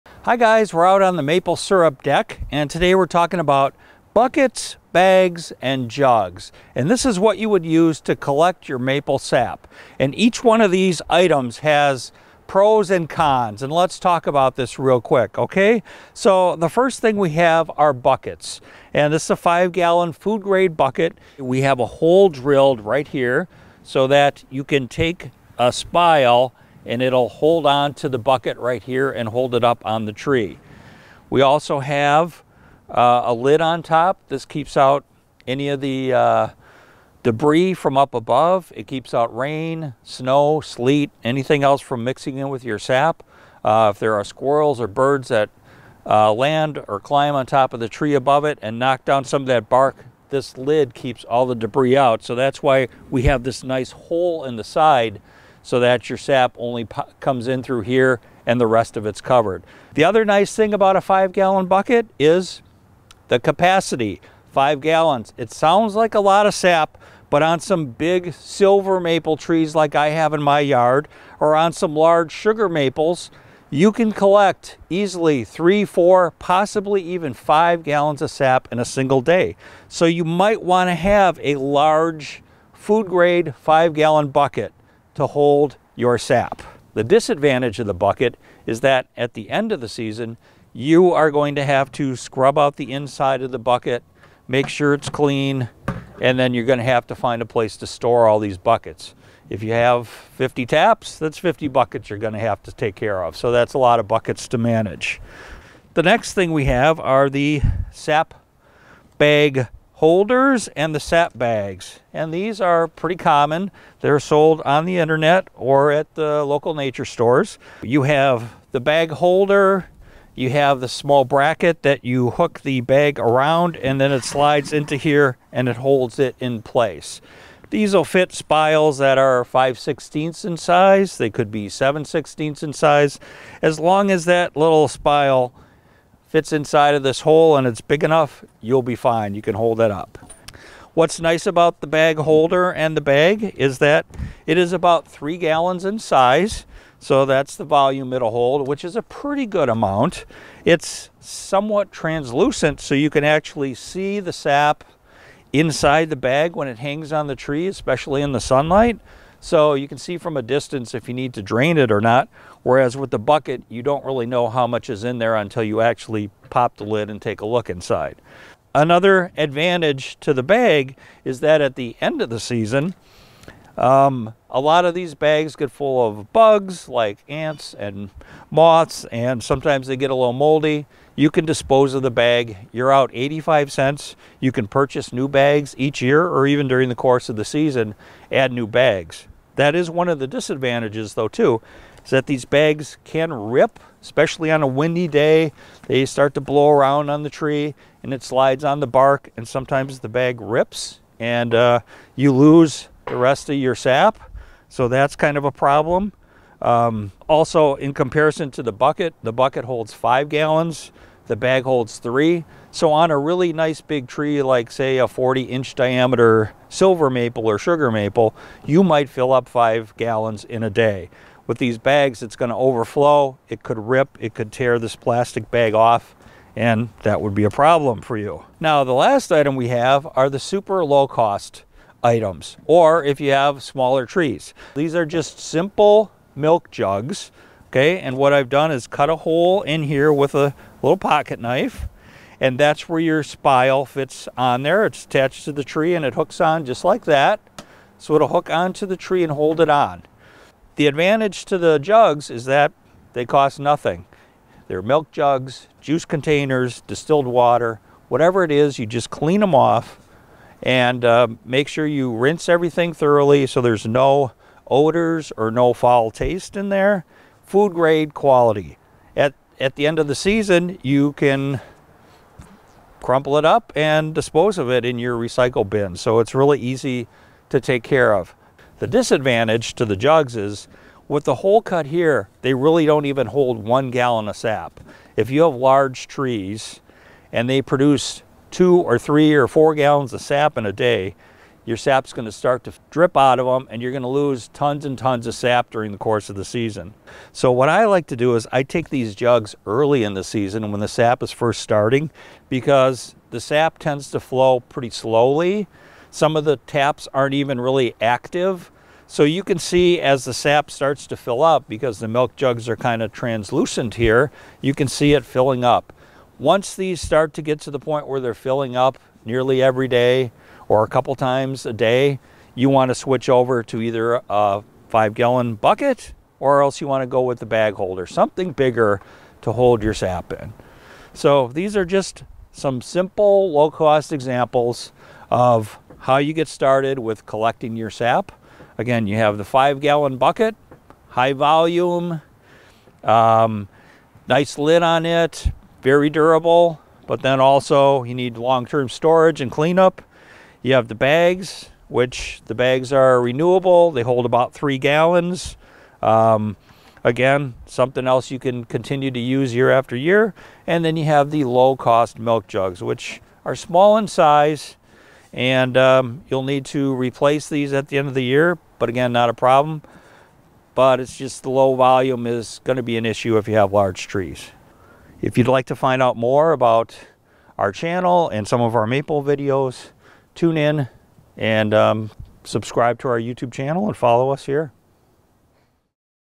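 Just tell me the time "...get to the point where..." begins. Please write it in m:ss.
5:17.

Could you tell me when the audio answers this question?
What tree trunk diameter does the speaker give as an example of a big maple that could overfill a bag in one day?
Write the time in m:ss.
3:35.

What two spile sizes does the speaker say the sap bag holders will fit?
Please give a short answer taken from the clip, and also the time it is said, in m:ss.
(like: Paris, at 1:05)
5/16 and 7/16, at 2:09.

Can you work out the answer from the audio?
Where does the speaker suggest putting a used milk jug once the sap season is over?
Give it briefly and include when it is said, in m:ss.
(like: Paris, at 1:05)
recycle bin, at 4:35.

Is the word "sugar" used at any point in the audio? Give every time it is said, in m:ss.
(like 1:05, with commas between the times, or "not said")
1:12, 3:37.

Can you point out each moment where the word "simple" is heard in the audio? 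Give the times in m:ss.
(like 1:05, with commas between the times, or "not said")
3:55, 5:32.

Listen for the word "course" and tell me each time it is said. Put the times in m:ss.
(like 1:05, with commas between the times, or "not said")
3:06, 4:55.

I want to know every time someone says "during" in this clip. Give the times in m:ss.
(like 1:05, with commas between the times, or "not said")
3:06, 4:55.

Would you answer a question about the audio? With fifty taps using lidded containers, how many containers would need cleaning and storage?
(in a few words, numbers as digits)
50 buckets.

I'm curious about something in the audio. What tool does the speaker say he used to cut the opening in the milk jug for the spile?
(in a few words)
pocket knife.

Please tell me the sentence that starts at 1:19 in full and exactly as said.
So you might want to have a large food grade five gallon bucket to hold your sap.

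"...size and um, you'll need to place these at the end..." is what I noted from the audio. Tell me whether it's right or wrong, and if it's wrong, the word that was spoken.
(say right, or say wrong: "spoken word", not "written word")
wrong: "replace", not "place".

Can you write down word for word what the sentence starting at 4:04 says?
It's attached to the tree and it hooks on just like that.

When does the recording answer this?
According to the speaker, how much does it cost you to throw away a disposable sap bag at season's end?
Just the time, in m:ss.
3:03.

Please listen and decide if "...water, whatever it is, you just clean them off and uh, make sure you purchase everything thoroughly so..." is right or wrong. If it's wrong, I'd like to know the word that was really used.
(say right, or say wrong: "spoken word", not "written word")
wrong: "rinse", not "purchase".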